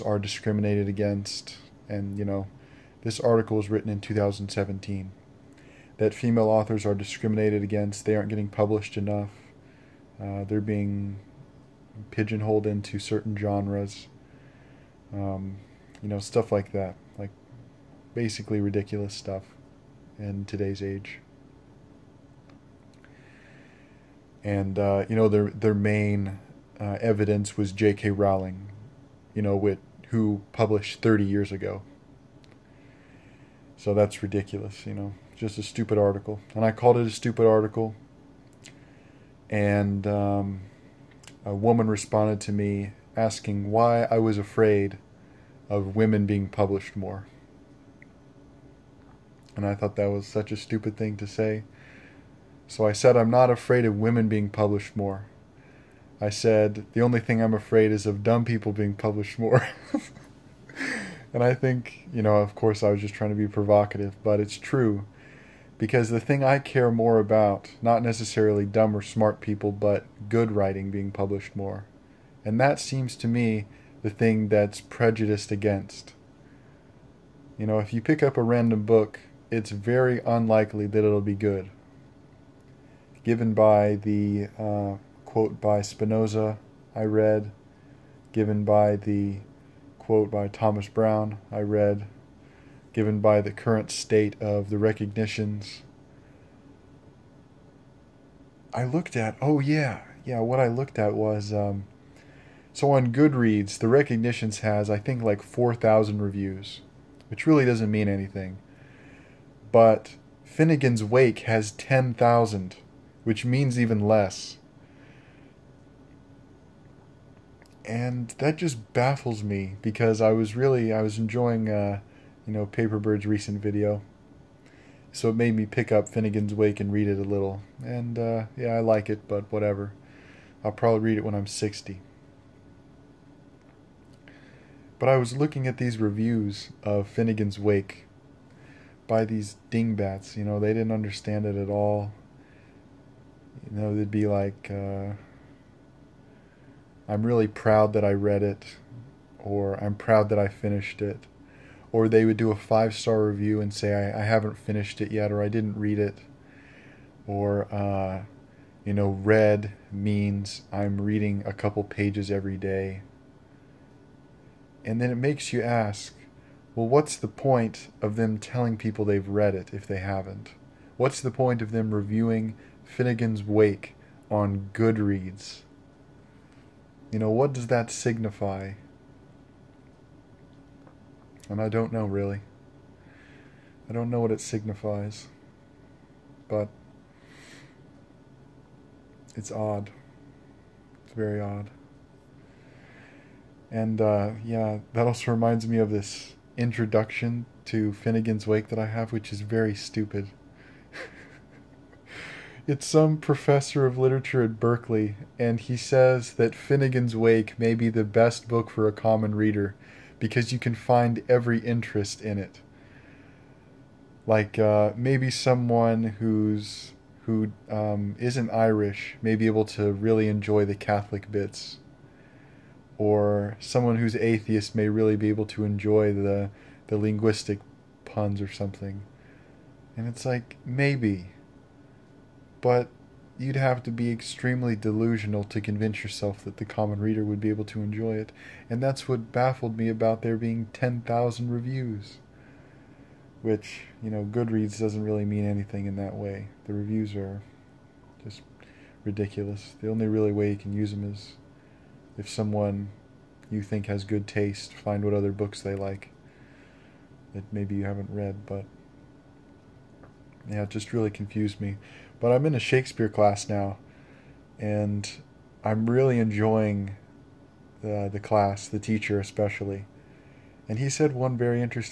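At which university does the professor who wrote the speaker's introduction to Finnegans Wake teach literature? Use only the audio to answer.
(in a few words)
Berkeley.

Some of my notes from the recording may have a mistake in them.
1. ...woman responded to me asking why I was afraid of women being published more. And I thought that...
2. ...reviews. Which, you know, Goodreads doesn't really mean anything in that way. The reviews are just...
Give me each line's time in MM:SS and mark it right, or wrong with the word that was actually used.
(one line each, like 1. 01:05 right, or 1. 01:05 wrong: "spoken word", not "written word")
1. 00:41 right
2. 04:01 right.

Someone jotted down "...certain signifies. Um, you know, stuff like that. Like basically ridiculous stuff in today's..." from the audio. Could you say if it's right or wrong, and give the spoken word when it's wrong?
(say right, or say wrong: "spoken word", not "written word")
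wrong: "genres", not "signifies".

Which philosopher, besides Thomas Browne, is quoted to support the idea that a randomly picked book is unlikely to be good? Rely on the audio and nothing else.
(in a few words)
Spinoza.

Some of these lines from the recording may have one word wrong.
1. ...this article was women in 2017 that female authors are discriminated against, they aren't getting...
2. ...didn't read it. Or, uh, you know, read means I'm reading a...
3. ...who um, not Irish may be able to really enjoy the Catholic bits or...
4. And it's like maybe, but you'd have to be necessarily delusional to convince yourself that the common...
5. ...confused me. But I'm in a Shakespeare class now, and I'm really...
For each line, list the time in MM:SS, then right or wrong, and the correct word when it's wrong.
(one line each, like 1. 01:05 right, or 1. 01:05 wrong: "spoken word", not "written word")
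1. 00:03 wrong: "written", not "women"
2. 02:35 right
3. 03:37 right
4. 03:49 wrong: "extremely", not "necessarily"
5. 04:21 right.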